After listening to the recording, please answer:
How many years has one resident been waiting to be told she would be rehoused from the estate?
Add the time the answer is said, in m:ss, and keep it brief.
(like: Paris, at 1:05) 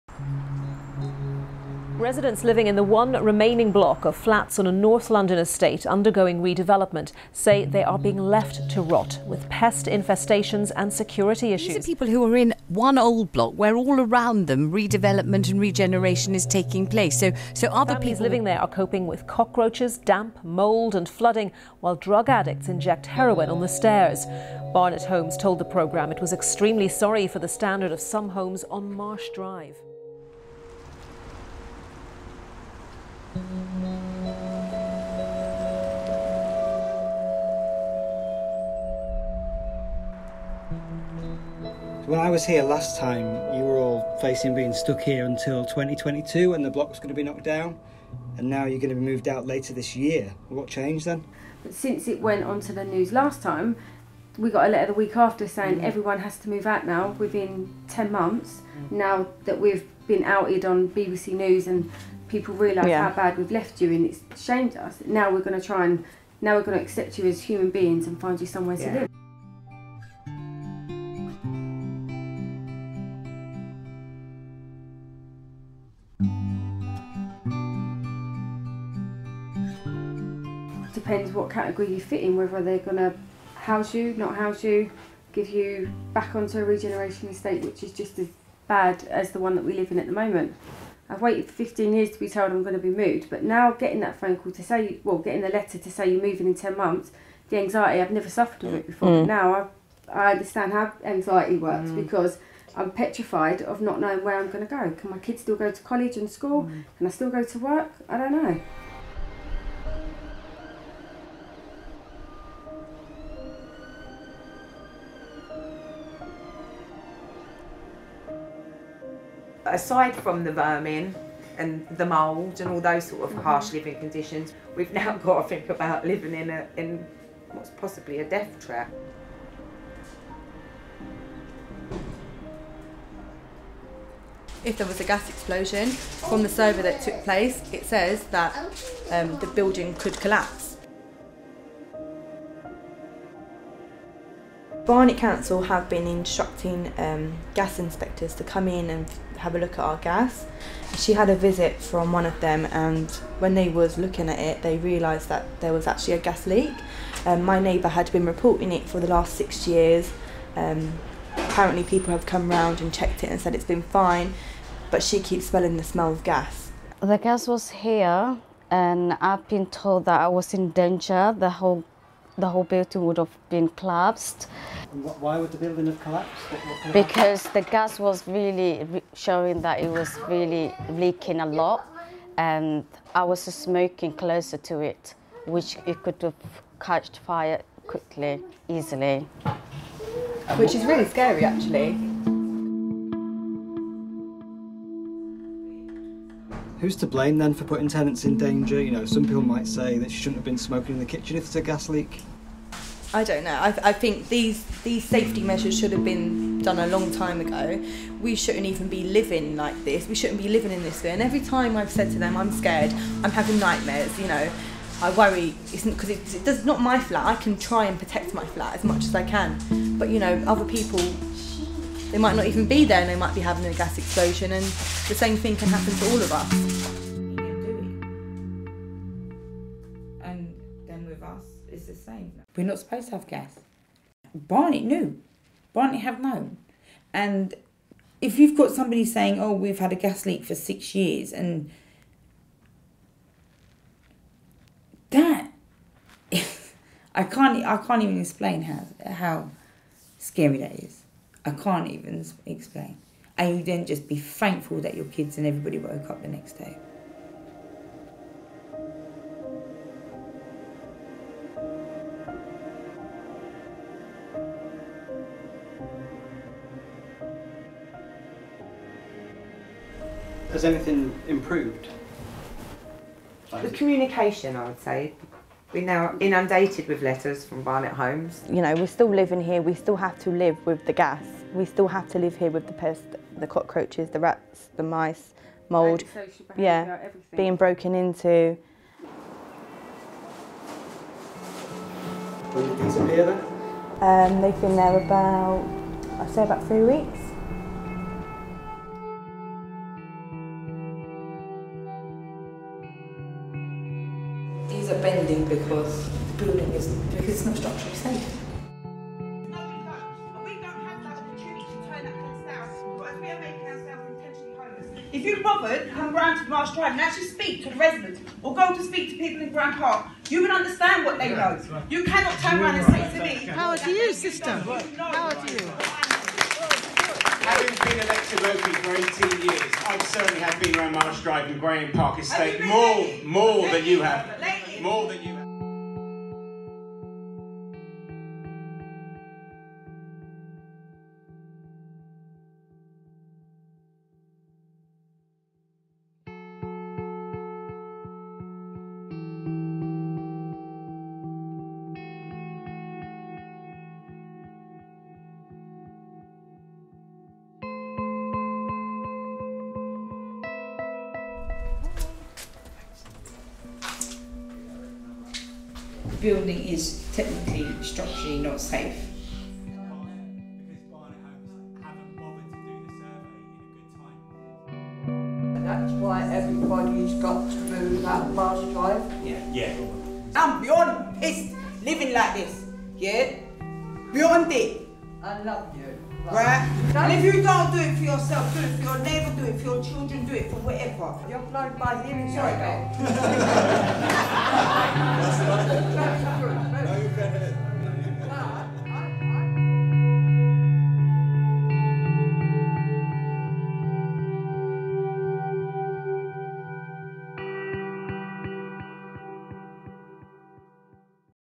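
15, at 1:31.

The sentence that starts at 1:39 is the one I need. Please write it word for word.
but now I, I understand how anxiety works mm.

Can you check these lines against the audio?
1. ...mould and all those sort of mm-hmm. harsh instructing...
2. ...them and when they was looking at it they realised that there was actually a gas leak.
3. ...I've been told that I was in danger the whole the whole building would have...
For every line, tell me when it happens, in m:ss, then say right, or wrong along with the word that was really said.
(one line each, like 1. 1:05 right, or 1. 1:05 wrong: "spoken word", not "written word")
1. 2:02 wrong: "living", not "instructing"
2. 2:32 right
3. 2:49 right.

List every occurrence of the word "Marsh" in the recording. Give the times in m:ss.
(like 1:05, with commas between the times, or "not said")
0:28, 5:16, 5:30.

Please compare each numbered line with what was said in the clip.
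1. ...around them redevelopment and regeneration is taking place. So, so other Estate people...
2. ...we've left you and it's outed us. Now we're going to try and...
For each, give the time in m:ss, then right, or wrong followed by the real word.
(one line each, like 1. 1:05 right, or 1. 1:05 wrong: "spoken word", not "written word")
1. 0:14 wrong: "Families", not "Estate"
2. 1:03 wrong: "shamed", not "outed".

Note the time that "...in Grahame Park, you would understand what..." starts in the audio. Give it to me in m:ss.
5:19.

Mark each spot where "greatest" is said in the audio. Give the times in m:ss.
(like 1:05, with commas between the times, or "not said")
not said.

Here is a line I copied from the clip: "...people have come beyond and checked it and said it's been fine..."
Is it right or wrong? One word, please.
wrong.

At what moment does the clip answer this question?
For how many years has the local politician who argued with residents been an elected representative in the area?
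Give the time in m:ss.
5:29.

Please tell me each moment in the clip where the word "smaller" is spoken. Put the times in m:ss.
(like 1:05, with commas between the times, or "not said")
not said.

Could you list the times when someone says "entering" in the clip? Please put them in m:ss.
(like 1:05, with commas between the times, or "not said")
not said.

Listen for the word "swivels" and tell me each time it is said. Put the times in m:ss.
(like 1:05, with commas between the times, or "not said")
not said.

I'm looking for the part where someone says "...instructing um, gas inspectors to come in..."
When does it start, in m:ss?
2:26.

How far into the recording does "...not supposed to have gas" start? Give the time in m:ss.
3:52.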